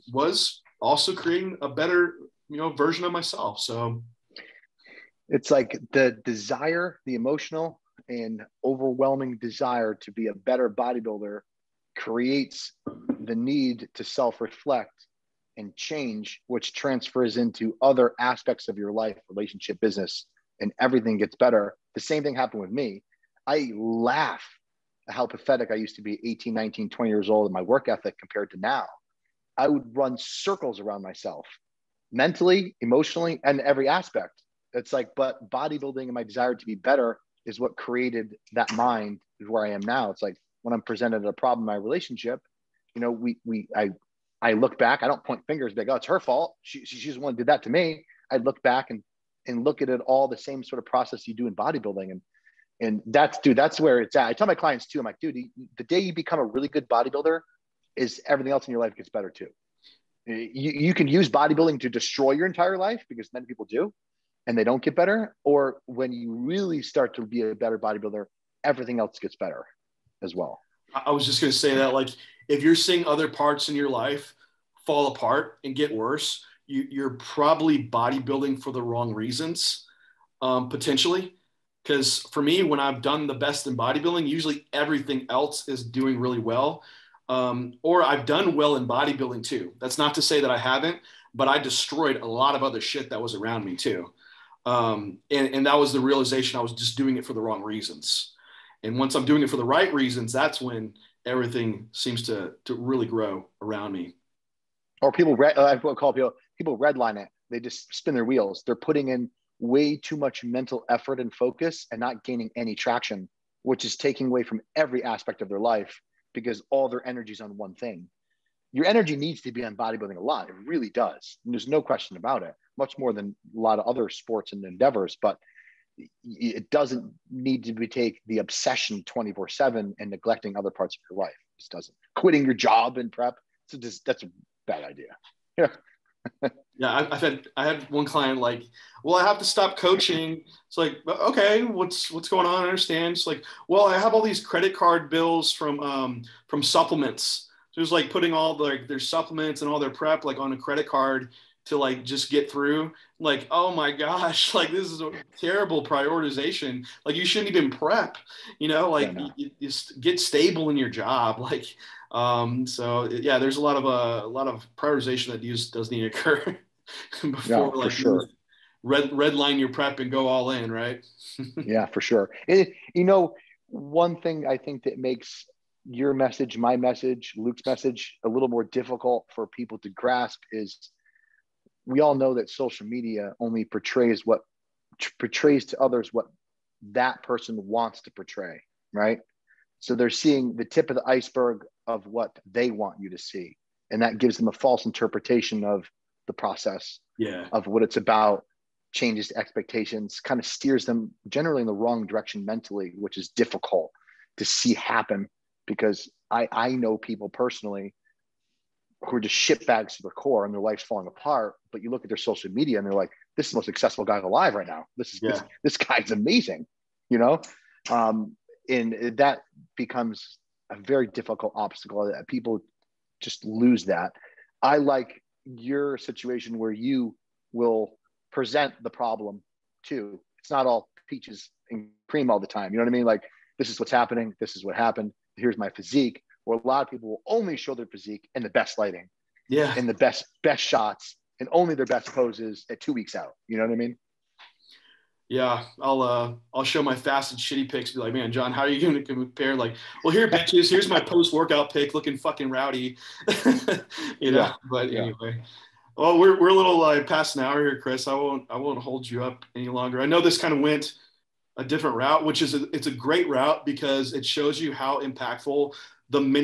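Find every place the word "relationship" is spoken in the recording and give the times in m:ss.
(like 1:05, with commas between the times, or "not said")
0:19, 0:41.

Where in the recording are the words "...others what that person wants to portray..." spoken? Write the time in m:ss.
3:05.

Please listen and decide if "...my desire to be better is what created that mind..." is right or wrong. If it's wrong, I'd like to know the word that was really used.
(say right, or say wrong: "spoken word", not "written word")
right.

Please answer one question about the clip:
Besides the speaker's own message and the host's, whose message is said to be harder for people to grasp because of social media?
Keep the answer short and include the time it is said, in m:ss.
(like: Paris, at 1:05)
Luke, at 2:57.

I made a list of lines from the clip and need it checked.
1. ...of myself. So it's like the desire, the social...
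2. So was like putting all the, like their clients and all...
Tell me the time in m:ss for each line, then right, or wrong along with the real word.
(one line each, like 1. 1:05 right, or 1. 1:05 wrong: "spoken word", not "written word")
1. 0:03 wrong: "emotional", not "social"
2. 2:27 wrong: "supplements", not "clients".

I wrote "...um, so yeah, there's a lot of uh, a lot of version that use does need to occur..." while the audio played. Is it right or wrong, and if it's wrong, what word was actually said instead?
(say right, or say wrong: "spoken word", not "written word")
wrong: "prioritization", not "version".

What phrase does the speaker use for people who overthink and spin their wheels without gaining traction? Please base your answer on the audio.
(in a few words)
redline it.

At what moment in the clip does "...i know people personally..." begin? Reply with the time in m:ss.
3:26.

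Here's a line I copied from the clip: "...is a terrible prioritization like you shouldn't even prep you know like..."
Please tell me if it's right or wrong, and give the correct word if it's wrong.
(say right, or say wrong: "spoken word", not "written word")
right.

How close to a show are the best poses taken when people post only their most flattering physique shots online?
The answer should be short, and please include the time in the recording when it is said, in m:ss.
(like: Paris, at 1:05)
2 weeks out, at 4:02.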